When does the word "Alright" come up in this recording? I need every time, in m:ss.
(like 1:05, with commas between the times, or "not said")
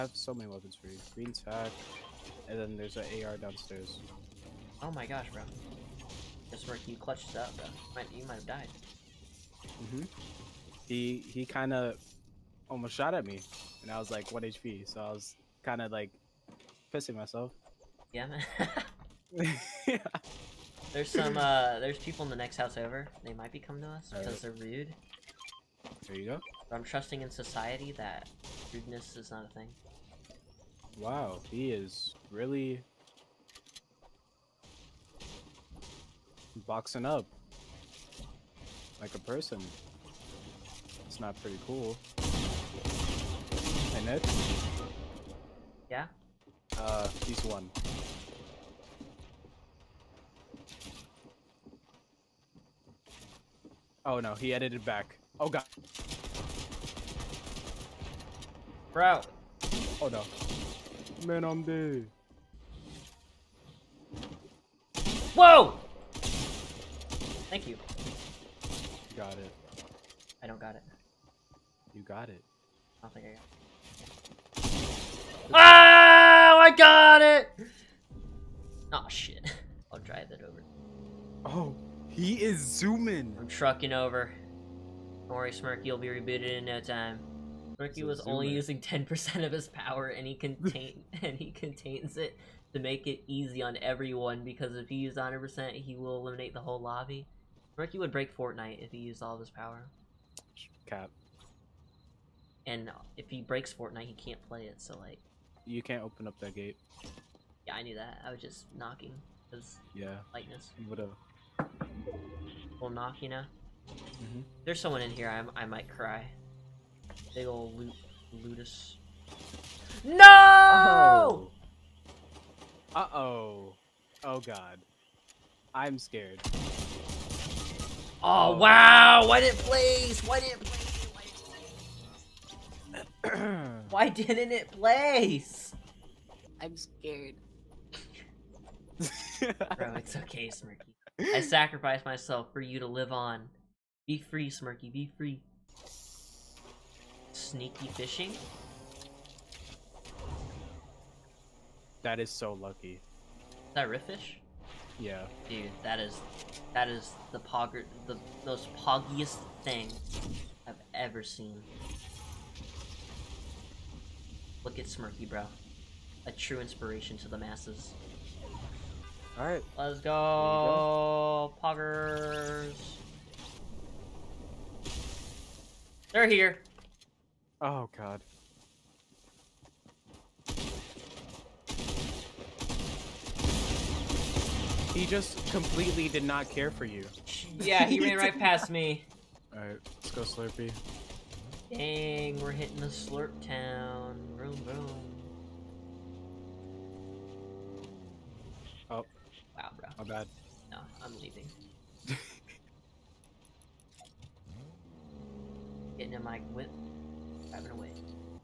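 2:49, 3:09.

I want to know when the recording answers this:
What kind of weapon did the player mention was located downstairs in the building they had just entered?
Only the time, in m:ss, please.
0:03.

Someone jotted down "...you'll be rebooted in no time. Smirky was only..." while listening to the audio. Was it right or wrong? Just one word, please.
right.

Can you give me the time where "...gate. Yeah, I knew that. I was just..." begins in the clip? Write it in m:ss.
1:46.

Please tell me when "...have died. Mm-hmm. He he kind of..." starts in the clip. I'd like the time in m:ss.
0:08.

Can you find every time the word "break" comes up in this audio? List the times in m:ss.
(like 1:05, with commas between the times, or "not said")
1:38, 1:43.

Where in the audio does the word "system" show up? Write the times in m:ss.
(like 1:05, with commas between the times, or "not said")
not said.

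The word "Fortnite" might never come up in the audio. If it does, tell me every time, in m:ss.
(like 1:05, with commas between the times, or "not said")
1:38, 1:43.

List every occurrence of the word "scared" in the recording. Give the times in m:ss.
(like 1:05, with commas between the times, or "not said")
2:05, 2:16.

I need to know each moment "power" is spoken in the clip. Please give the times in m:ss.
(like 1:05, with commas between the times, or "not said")
1:29, 1:39.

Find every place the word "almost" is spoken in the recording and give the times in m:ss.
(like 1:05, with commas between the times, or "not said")
0:12.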